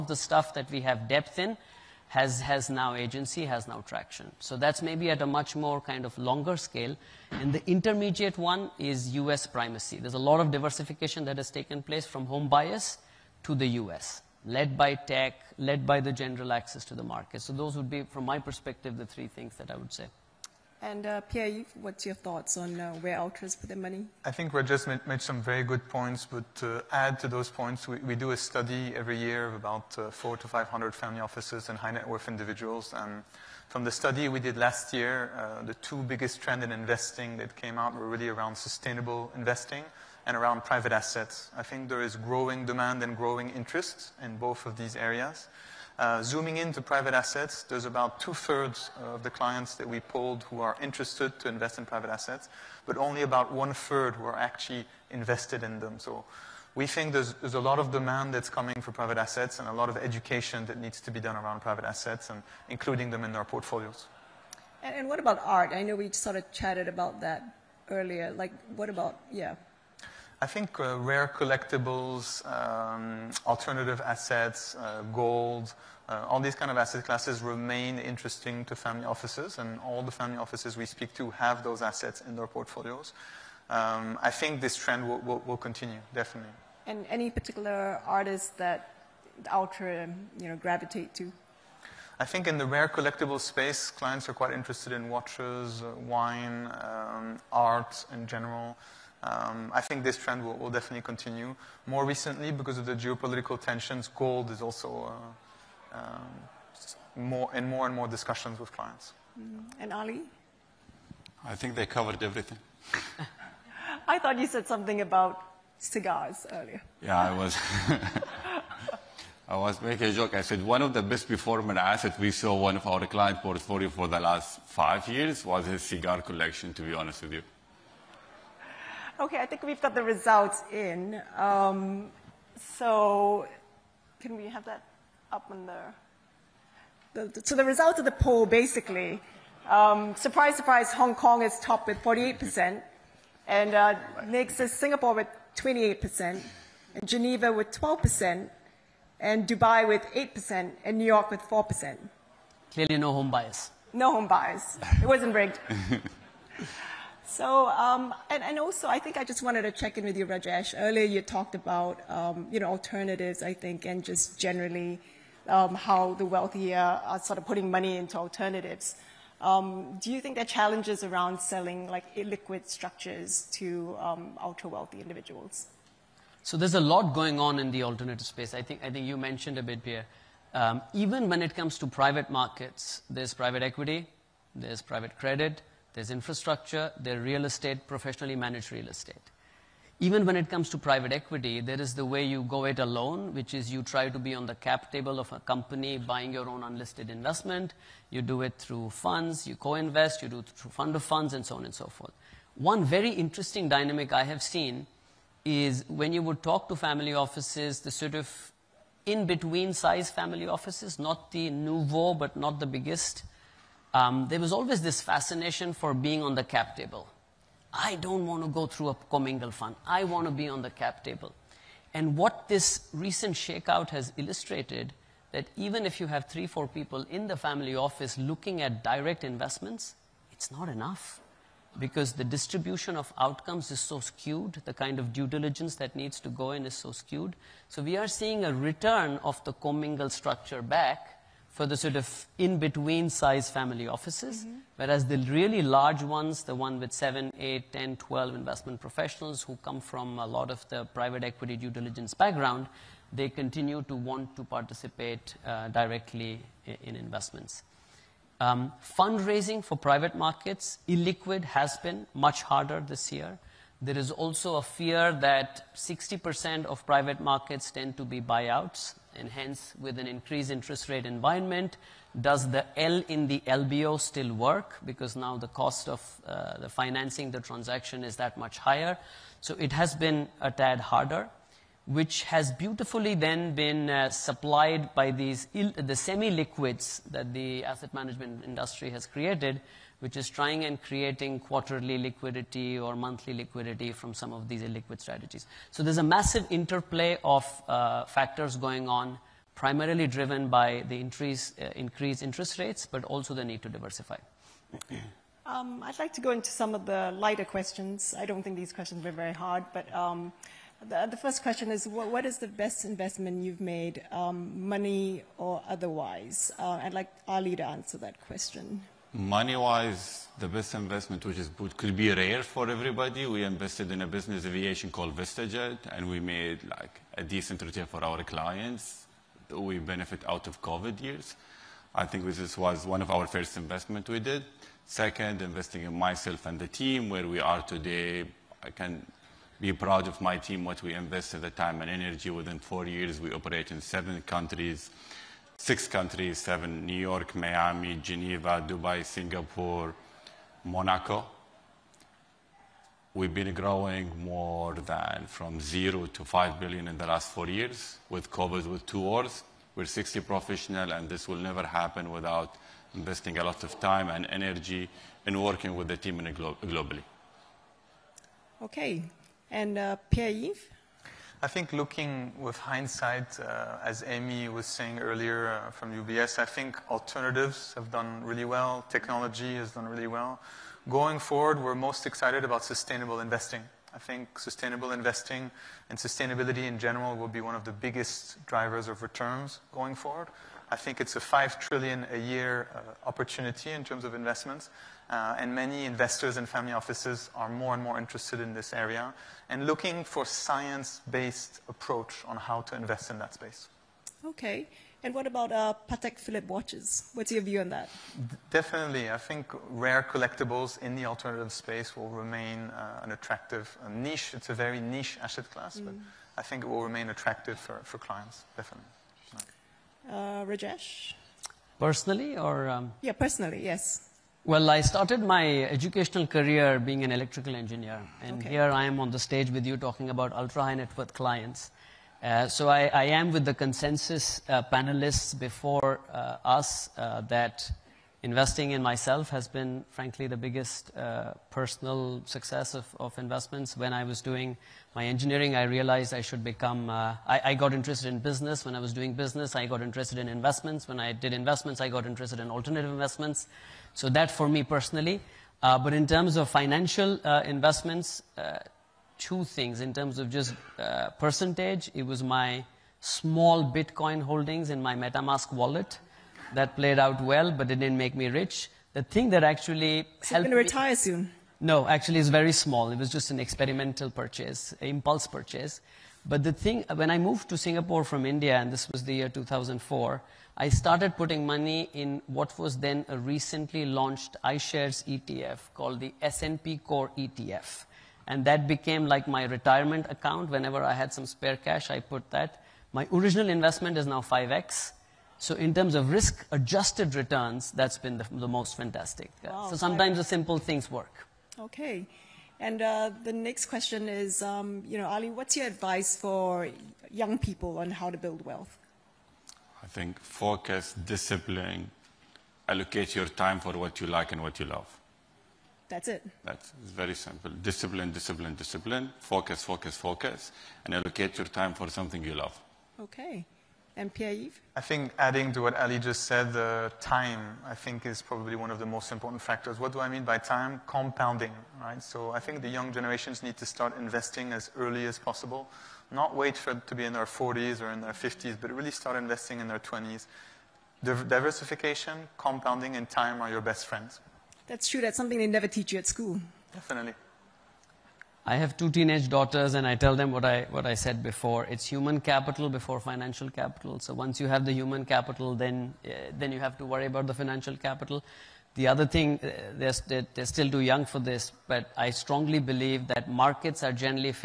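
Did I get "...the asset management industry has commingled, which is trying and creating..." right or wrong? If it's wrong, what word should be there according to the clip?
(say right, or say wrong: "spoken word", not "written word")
wrong: "created", not "commingled".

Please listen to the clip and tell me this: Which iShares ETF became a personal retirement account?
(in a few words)
S&P Core ETF.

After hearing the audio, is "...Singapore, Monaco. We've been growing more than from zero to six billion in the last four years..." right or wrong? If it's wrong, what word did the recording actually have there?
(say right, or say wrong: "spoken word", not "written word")
wrong: "five", not "six".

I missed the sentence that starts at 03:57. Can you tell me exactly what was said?
So we are seeing a return of the commingled structure back for the sort of in-between size family offices, mm-hmm.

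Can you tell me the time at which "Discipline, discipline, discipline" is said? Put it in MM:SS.
08:37.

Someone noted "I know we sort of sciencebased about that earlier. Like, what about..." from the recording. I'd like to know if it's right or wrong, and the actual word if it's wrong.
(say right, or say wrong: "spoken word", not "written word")
wrong: "chatted", not "sciencebased".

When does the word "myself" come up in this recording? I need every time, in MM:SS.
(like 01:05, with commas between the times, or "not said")
05:35, 07:18.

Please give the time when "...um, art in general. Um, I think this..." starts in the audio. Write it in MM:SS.
01:36.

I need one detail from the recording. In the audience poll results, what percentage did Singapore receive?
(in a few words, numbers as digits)
28%.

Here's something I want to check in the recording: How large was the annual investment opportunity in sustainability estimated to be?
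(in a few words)
5 trillion a year.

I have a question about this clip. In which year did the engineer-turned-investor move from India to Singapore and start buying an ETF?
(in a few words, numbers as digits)
2004.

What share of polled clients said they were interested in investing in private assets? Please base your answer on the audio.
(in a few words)
two-thirds.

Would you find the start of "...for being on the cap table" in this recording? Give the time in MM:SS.
03:35.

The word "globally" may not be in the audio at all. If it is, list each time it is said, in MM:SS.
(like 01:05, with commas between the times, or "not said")
06:06.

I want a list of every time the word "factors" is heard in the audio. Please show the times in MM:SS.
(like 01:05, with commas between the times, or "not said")
04:58, 08:49.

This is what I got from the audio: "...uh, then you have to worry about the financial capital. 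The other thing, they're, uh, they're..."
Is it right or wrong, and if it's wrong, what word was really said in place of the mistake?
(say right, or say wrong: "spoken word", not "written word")
right.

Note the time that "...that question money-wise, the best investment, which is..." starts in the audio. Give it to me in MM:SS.
05:17.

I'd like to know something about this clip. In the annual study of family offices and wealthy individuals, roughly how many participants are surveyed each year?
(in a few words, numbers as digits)
400 to 500.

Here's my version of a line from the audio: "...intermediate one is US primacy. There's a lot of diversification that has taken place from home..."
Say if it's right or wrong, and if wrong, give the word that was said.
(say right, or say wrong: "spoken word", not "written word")
right.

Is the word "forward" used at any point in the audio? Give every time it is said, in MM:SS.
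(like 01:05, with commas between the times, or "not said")
06:21, 06:29.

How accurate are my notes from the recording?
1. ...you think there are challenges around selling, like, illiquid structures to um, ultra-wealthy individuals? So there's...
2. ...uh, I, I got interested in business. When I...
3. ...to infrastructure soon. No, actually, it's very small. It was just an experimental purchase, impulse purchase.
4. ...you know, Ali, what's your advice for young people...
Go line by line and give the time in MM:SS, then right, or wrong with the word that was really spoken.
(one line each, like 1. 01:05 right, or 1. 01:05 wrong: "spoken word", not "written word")
1. 02:50 right
2. 07:26 right
3. 07:50 wrong: "retire", not "infrastructure"
4. 08:24 right.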